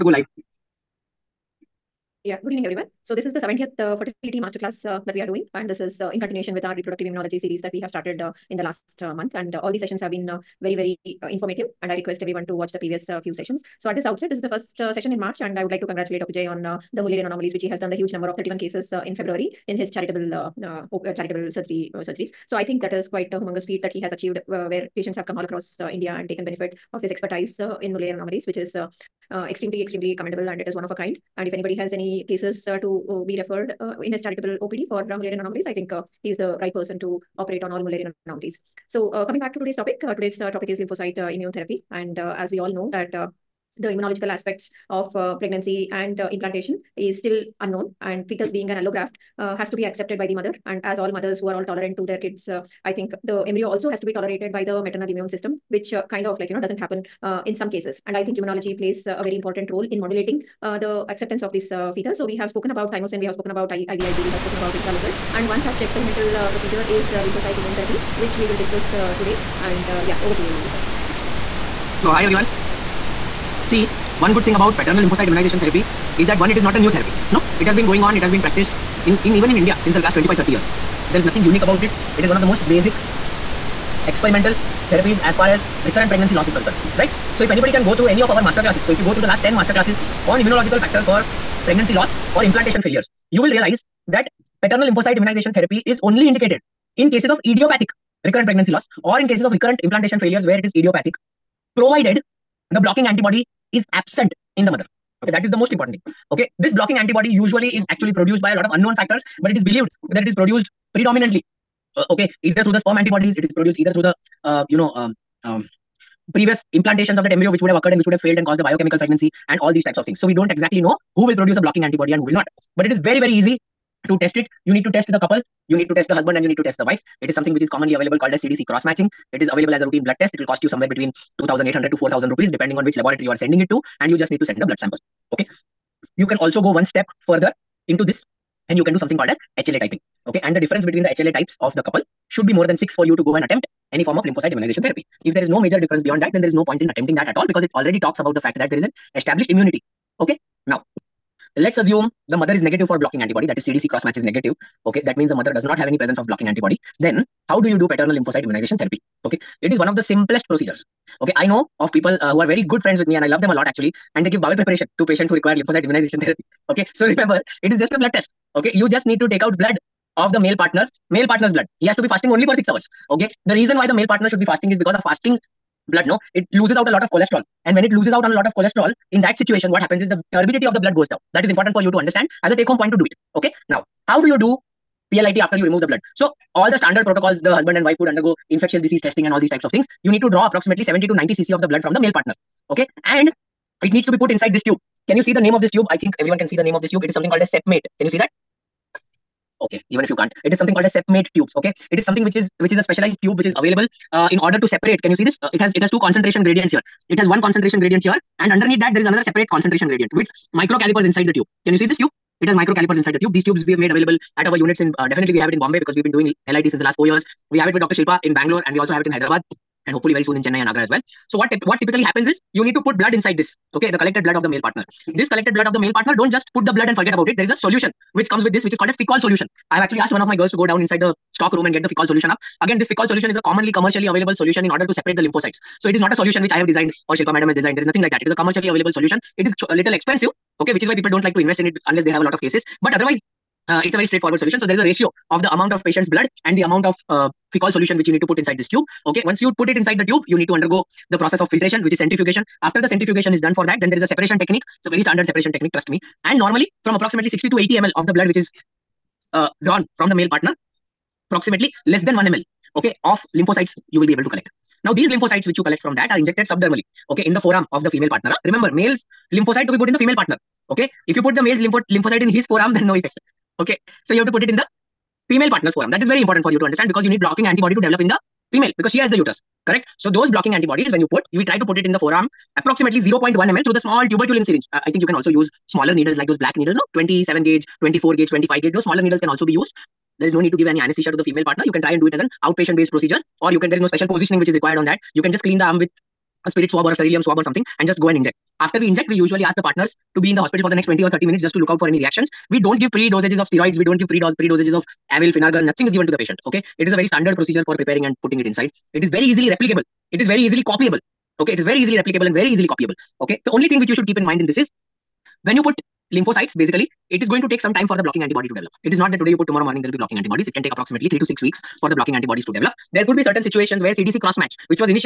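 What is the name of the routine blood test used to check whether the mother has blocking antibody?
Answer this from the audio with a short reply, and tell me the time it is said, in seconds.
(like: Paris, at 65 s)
CDC cross matching, at 128 s.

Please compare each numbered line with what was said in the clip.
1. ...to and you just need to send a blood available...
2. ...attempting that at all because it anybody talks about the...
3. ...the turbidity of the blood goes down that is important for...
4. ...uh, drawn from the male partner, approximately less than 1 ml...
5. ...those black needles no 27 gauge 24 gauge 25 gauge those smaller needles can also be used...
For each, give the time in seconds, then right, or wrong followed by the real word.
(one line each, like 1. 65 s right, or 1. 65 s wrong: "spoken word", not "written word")
1. 133 s wrong: "sample", not "available"
2. 146 s wrong: "already", not "anybody"
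3. 180 s right
4. 259 s right
5. 286 s right.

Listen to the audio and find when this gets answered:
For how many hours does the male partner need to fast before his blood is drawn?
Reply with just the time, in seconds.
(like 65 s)
172 s.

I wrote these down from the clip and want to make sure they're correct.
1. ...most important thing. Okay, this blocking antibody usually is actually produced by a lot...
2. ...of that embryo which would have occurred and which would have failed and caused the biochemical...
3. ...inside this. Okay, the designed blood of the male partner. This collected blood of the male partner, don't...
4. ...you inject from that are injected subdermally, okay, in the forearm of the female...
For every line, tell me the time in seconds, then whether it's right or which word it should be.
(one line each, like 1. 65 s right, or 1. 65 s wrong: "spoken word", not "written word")
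1. 105 s right
2. 117 s right
3. 223 s wrong: "collected", not "designed"
4. 265 s wrong: "collect", not "inject".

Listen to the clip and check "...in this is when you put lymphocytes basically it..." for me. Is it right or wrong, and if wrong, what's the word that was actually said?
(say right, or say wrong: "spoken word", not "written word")
right.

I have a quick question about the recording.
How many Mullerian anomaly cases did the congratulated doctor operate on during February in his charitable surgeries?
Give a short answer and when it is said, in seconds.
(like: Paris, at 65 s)
31, at 18 s.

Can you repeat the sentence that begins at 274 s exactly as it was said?
So you have to put it in the female partner's forearm.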